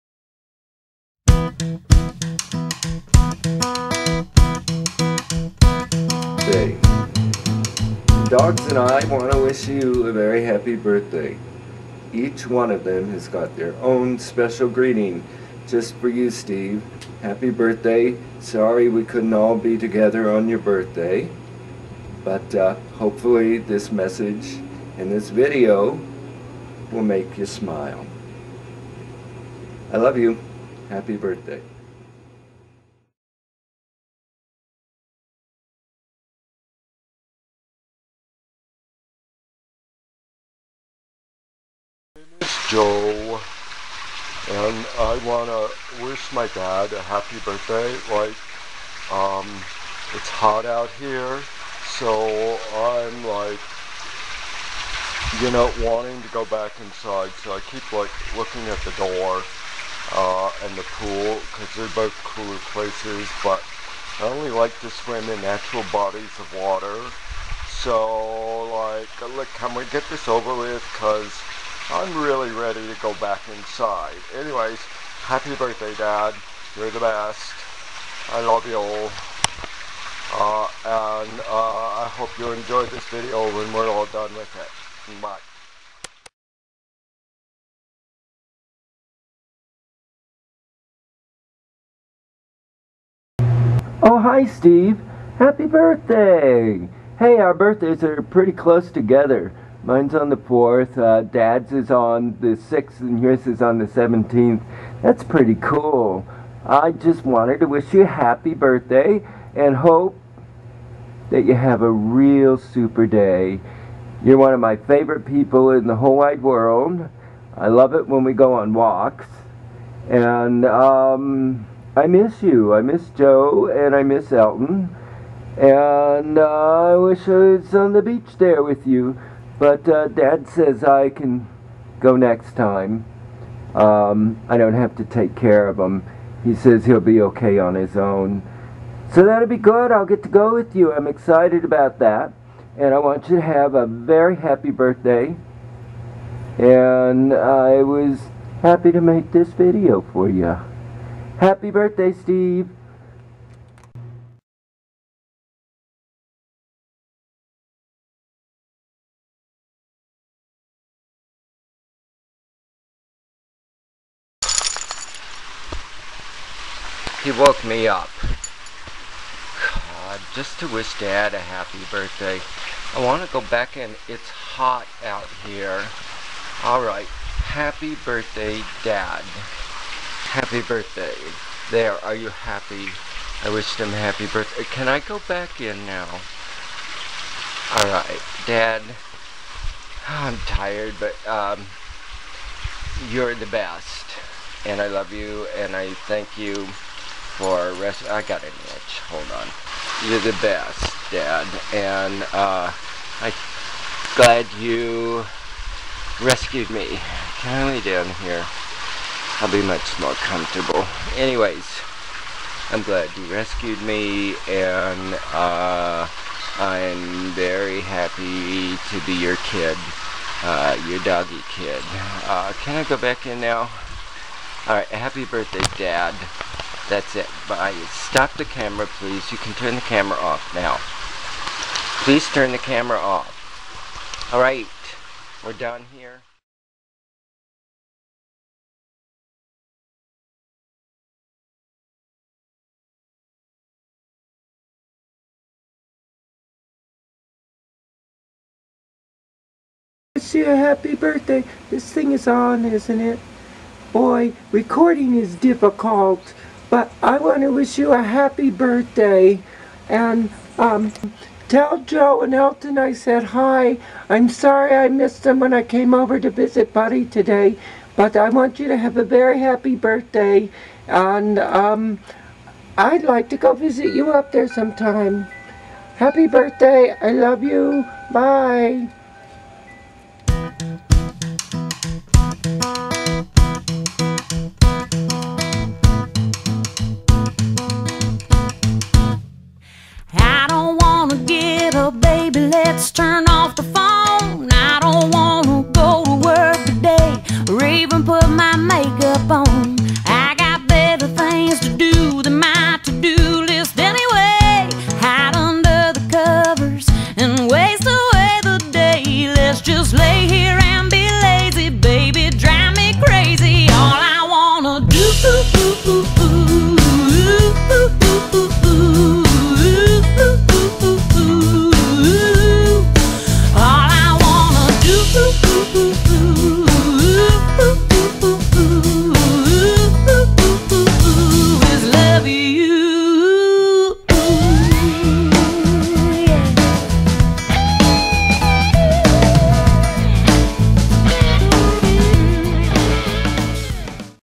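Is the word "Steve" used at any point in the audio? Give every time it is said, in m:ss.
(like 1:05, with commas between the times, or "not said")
0:16, 1:34, 2:32.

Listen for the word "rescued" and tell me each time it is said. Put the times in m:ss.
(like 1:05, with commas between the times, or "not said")
3:26, 3:33.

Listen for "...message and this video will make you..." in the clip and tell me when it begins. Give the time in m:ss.
0:23.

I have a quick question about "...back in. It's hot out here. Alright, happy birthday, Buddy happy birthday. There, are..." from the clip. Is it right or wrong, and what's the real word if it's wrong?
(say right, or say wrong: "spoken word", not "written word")
wrong: "Dad", not "Buddy".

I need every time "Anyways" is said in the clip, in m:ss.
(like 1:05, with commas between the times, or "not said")
1:14, 3:31.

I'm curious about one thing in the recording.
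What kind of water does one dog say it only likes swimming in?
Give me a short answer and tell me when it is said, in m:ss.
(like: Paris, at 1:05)
natural bodies of water, at 1:05.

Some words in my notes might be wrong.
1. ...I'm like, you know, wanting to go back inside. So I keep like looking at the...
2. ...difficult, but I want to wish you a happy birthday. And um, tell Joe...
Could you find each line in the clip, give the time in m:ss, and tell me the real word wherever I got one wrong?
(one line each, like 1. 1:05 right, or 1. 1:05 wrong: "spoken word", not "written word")
1. 0:52 right
2. 4:15 right.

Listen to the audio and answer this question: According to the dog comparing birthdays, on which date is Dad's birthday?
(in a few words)
the 6th.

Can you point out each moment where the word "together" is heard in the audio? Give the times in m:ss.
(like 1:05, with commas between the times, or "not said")
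0:19, 1:38.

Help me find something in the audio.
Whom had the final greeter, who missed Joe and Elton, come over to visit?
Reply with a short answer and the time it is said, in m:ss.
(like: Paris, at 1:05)
Buddy, at 4:26.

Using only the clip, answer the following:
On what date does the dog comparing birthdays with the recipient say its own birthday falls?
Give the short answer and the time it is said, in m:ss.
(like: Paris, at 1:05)
the 4th, at 1:40.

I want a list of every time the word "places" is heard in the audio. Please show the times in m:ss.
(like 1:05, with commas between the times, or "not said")
1:02.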